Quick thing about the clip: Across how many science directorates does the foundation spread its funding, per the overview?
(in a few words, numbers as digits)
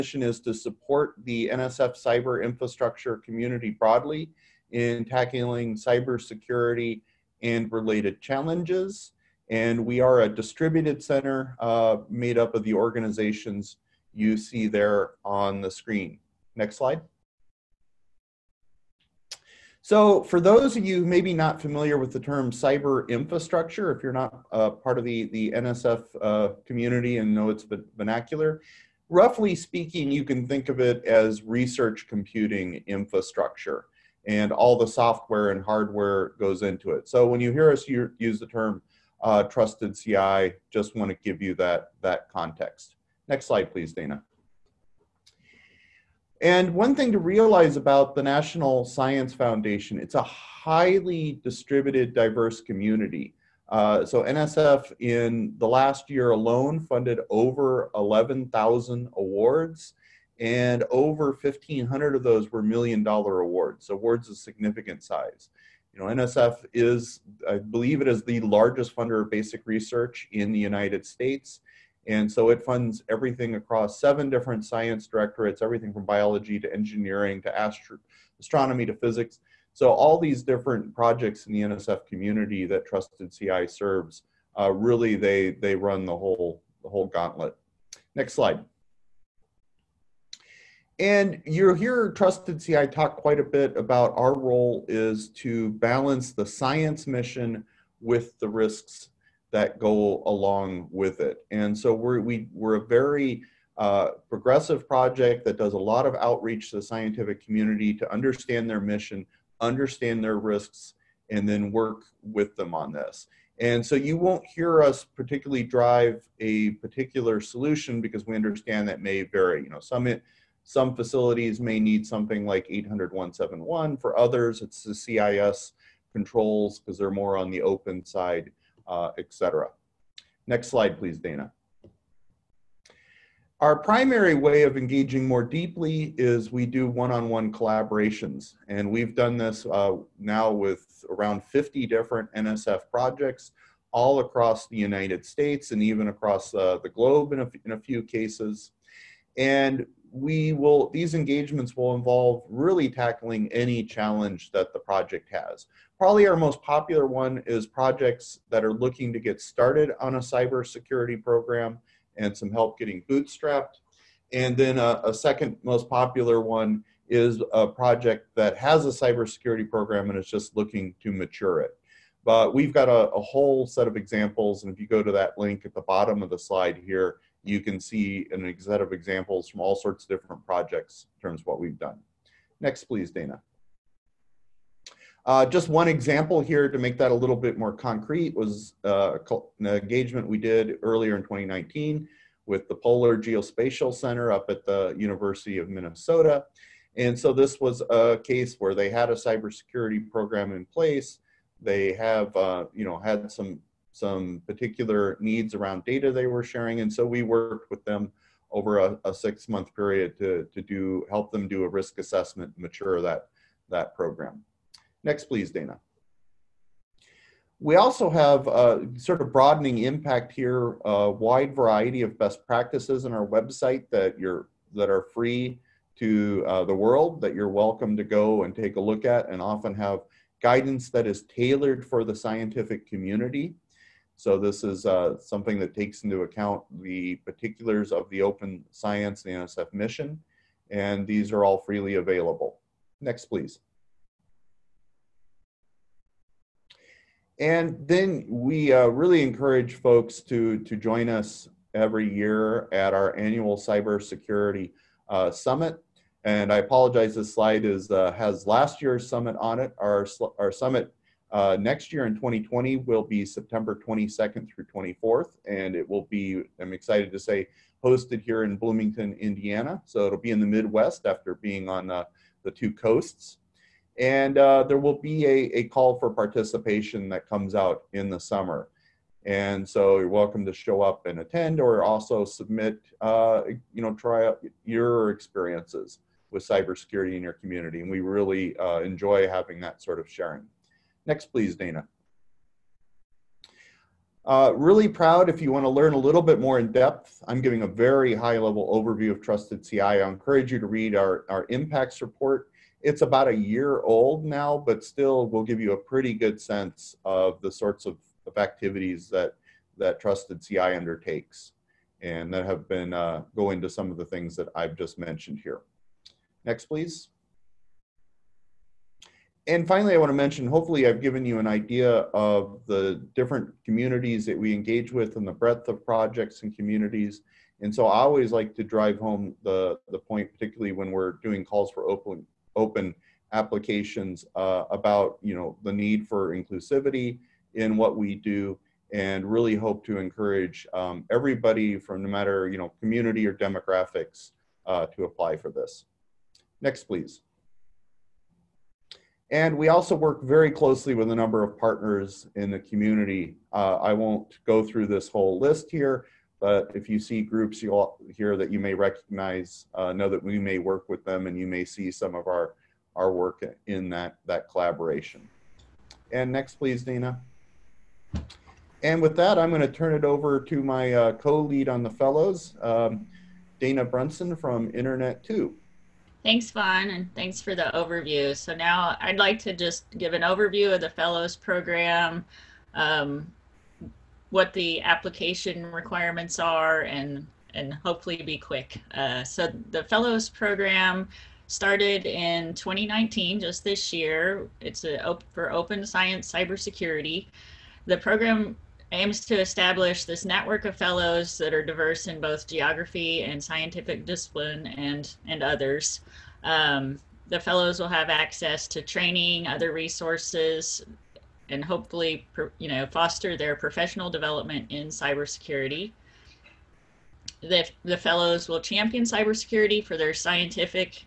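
7.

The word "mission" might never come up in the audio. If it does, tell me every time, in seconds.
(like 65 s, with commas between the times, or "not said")
97 s, 108 s, 239 s.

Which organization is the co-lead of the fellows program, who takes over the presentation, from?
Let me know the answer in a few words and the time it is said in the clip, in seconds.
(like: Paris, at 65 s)
Internet2, at 374 s.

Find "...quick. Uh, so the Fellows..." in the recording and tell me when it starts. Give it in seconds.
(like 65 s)
388 s.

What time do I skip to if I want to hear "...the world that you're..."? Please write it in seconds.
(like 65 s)
226 s.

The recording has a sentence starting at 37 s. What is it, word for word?
So, when you hear us use the term uh, trusted CI, just want to give you that, that context.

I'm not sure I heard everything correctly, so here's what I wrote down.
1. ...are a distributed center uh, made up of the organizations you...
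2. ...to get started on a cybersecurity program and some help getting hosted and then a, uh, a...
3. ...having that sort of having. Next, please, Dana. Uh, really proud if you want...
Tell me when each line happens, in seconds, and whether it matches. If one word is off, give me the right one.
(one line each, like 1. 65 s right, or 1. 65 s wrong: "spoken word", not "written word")
1. 10 s right
2. 159 s wrong: "bootstrapped", not "hosted"
3. 289 s wrong: "sharing", not "having".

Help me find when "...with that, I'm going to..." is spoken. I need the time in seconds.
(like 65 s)
369 s.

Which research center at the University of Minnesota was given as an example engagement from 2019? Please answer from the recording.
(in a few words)
Polar Geospatial Center.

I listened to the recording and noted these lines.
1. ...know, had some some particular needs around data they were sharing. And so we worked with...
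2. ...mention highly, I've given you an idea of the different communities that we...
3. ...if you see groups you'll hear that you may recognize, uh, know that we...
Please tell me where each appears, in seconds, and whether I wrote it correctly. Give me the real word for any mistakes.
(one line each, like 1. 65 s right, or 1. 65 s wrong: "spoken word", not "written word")
1. 202 s right
2. 320 s wrong: "hopefully", not "highly"
3. 356 s right.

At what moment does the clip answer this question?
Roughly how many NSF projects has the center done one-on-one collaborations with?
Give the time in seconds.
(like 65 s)
141 s.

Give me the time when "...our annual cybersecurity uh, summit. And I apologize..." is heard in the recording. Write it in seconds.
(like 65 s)
252 s.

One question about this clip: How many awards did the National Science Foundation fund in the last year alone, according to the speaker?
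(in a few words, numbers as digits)
over 11,000.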